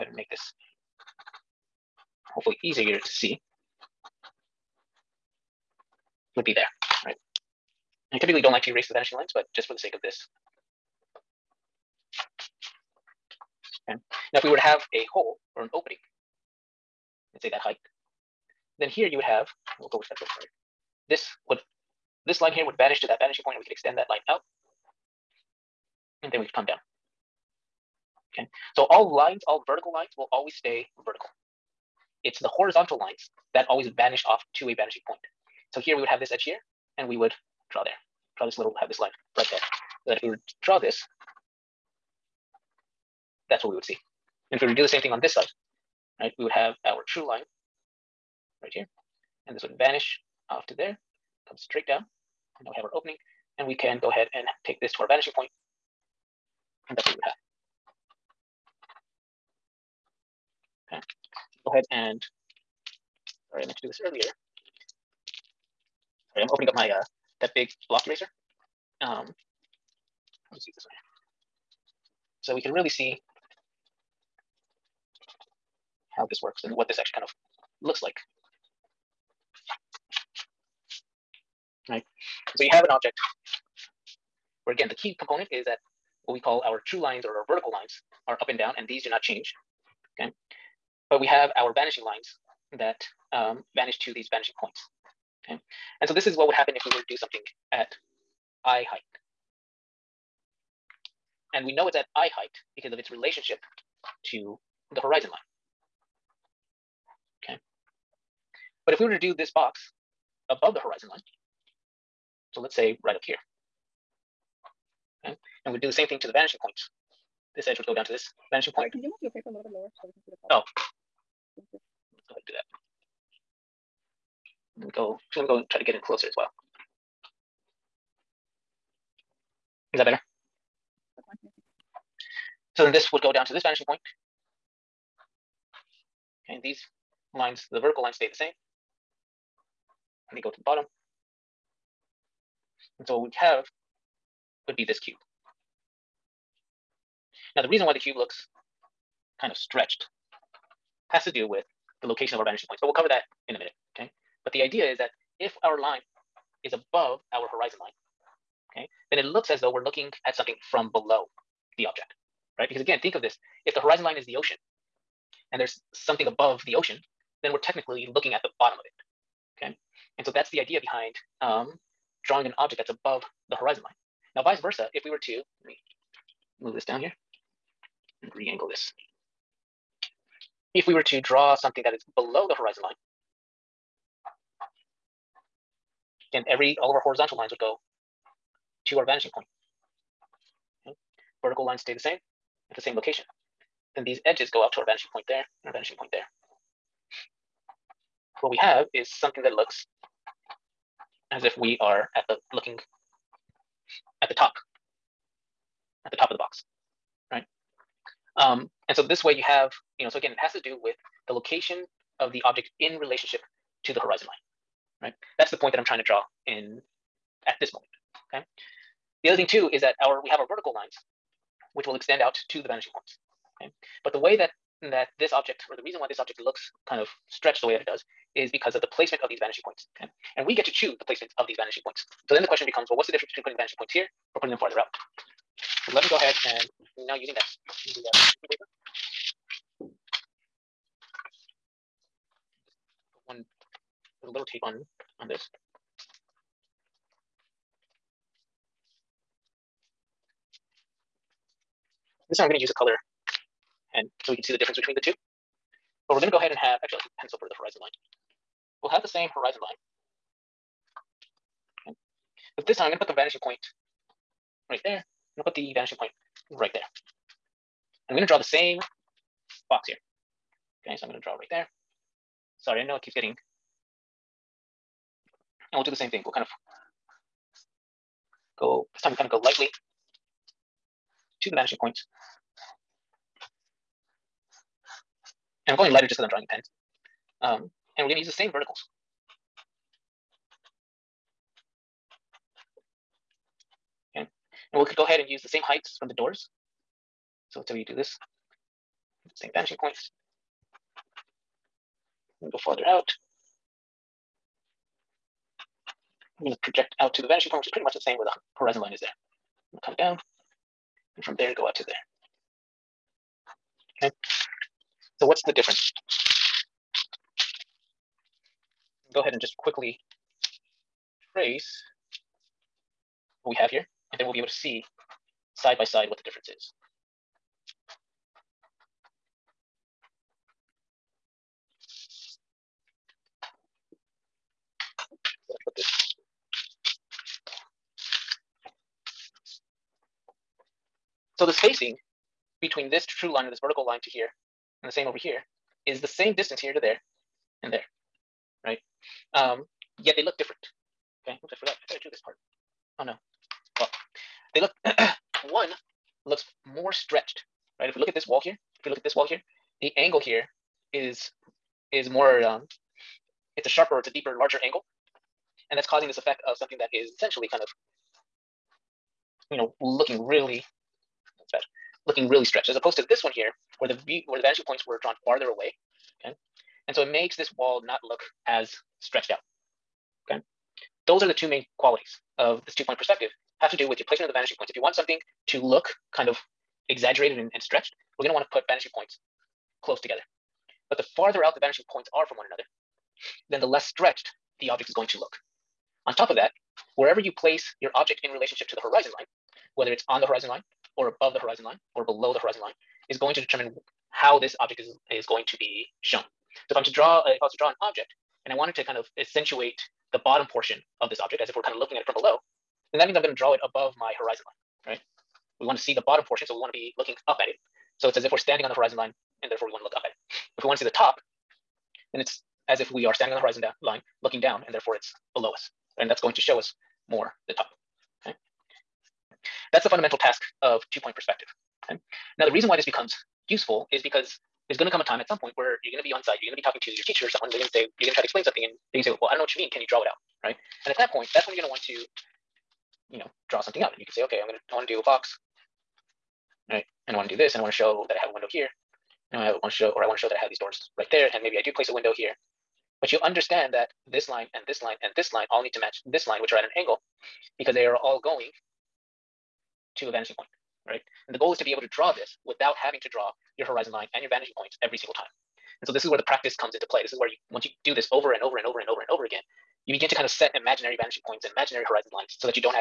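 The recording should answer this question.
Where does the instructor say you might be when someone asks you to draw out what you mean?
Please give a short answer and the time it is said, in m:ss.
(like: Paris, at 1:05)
on site, at 7:16.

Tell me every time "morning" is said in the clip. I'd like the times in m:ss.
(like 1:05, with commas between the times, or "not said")
not said.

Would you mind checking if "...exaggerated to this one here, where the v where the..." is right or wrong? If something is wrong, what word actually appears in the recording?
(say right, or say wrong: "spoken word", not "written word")
wrong: "opposed", not "exaggerated".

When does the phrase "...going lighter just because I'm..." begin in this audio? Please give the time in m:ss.
4:45.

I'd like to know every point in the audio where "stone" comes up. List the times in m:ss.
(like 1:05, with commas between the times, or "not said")
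not said.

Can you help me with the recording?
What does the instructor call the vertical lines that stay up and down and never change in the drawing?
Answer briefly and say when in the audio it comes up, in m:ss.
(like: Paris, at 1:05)
true lines, at 1:26.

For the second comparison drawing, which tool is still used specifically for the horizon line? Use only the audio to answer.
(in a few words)
pencil.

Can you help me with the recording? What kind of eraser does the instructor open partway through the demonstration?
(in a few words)
big block eraser.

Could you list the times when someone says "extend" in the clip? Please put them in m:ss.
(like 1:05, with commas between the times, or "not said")
0:23, 3:41.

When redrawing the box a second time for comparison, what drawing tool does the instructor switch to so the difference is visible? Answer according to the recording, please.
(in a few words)
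color pen.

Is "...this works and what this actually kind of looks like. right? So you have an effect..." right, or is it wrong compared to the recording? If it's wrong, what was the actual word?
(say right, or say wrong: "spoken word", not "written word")
wrong: "object", not "effect".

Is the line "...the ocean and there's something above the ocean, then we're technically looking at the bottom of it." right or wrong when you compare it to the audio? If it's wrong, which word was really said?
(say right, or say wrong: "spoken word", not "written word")
right.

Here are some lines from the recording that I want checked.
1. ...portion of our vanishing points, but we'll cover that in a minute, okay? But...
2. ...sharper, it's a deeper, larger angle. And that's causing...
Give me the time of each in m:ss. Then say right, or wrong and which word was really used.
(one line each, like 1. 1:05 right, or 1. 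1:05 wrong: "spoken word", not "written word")
1. 2:32 wrong: "location", not "portion"
2. 6:03 right.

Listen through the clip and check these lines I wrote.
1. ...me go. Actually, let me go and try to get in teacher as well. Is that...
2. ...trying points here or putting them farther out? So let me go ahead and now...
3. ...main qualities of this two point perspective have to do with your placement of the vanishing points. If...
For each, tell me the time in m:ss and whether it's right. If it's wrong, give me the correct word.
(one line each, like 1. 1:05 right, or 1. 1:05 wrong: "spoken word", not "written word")
1. 2:04 wrong: "closer", not "teacher"
2. 3:53 wrong: "vanishing", not "trying"
3. 6:21 right.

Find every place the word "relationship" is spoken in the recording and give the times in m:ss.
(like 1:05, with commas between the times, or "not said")
1:43, 3:32, 6:38.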